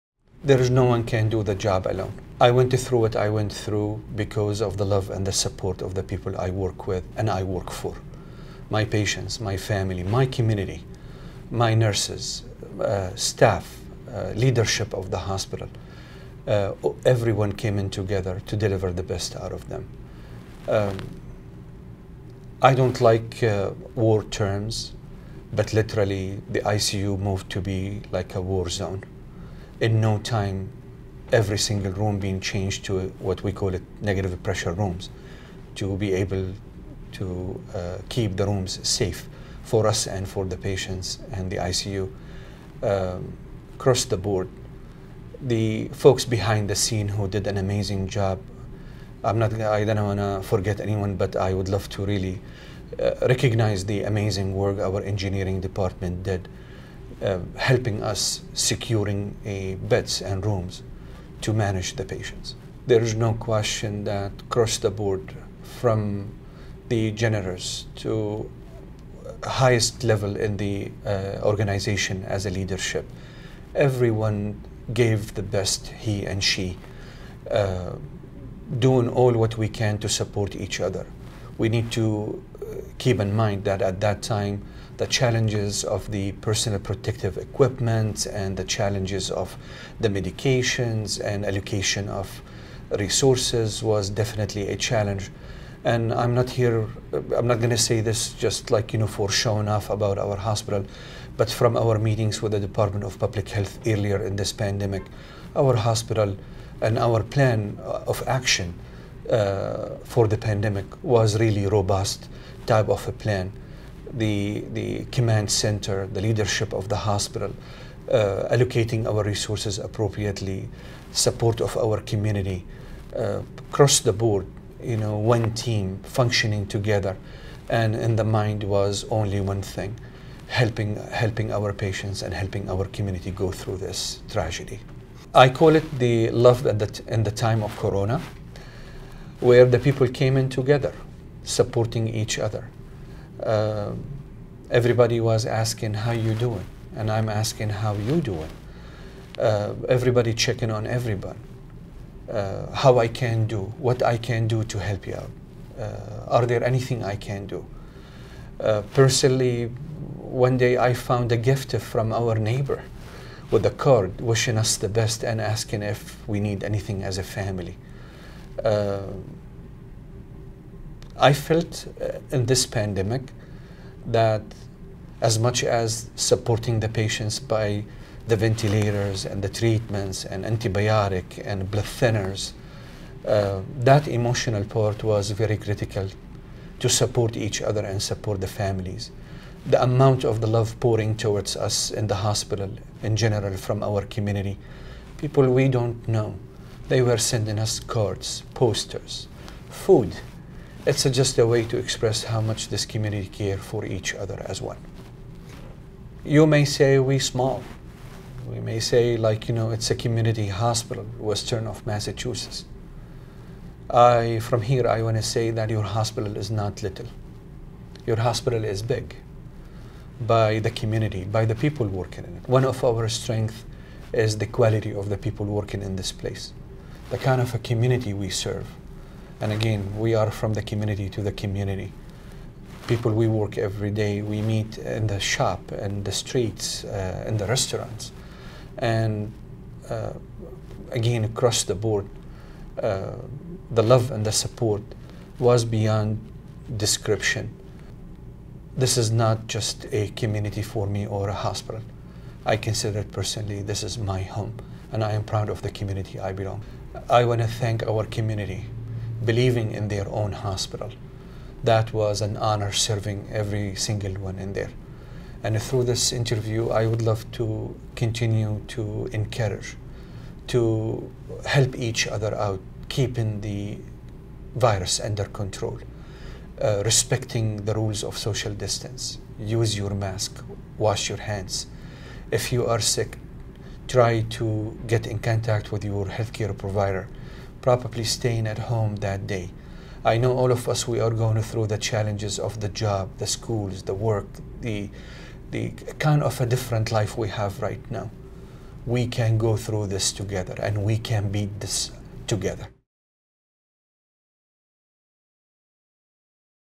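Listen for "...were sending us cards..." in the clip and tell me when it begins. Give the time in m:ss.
3:17.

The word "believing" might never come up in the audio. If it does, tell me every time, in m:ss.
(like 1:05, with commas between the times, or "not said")
4:19.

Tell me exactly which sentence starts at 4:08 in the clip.
This is not just a community for me or a hospital.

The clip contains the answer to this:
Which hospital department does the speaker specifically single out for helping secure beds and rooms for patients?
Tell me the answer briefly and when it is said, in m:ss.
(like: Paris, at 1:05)
engineering department, at 0:55.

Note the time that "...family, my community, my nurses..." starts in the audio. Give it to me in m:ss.
0:09.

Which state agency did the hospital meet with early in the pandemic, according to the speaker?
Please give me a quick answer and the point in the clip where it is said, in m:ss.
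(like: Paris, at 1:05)
Department of Public Health, at 1:42.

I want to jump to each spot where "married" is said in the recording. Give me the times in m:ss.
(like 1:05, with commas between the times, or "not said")
not said.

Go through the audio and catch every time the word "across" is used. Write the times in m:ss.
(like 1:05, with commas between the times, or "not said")
0:43, 1:04, 2:03, 4:01.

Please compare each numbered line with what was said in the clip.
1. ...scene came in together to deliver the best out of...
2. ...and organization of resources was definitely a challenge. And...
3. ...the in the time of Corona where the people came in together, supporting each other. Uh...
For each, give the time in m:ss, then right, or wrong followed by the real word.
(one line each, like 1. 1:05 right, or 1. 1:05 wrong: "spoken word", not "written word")
1. 0:17 wrong: "everyone", not "scene"
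2. 1:31 wrong: "allocation", not "organization"
3. 2:16 right.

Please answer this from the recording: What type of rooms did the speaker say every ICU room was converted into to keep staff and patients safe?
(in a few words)
negative pressure rooms.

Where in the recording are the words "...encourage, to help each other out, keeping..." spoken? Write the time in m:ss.
4:29.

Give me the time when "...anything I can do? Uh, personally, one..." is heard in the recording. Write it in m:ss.
2:36.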